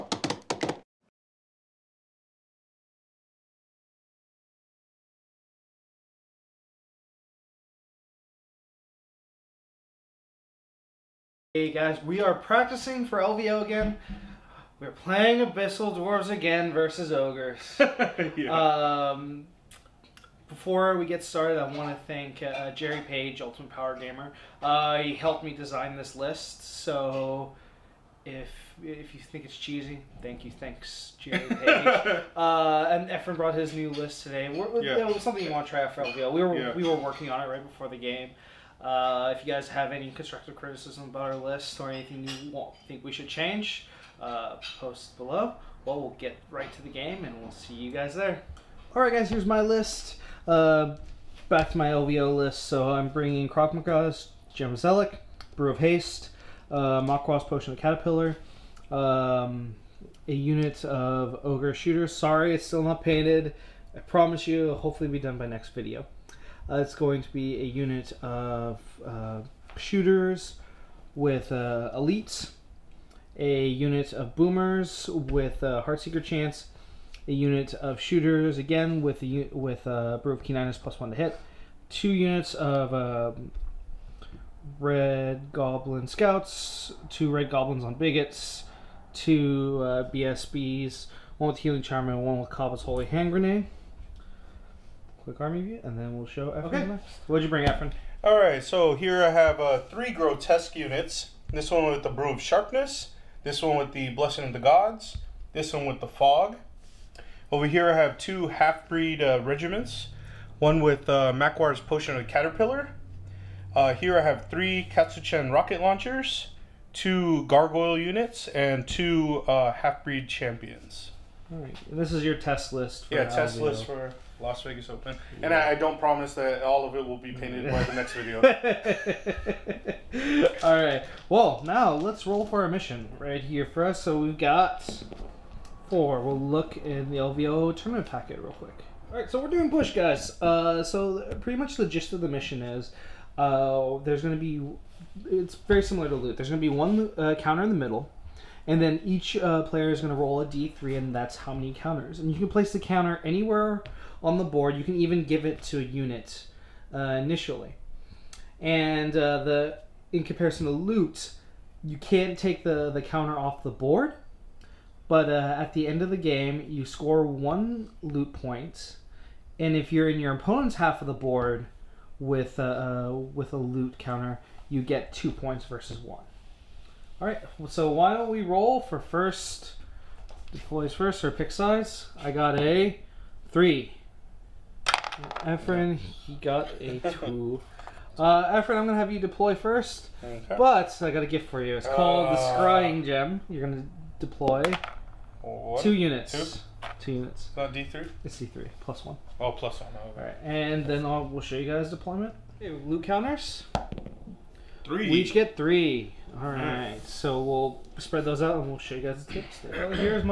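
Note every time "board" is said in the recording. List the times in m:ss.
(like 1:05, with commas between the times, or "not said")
2:34, 2:43, 2:51.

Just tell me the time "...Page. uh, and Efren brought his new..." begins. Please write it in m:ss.
0:31.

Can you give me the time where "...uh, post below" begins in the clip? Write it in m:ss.
0:44.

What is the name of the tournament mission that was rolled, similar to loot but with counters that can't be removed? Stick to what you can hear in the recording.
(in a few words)
Push.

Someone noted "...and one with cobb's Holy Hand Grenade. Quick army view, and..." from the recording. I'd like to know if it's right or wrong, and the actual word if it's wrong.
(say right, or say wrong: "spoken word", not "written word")
right.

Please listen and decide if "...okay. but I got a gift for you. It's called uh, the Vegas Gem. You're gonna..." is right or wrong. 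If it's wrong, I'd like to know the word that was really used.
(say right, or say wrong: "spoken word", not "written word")
wrong: "Scrying", not "Vegas".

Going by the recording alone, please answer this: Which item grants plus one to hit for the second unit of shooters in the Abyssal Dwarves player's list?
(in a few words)
Brew of Keen.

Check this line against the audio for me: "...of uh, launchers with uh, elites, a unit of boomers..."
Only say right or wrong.
wrong.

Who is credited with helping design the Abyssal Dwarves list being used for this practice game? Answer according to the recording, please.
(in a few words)
Jerry Page.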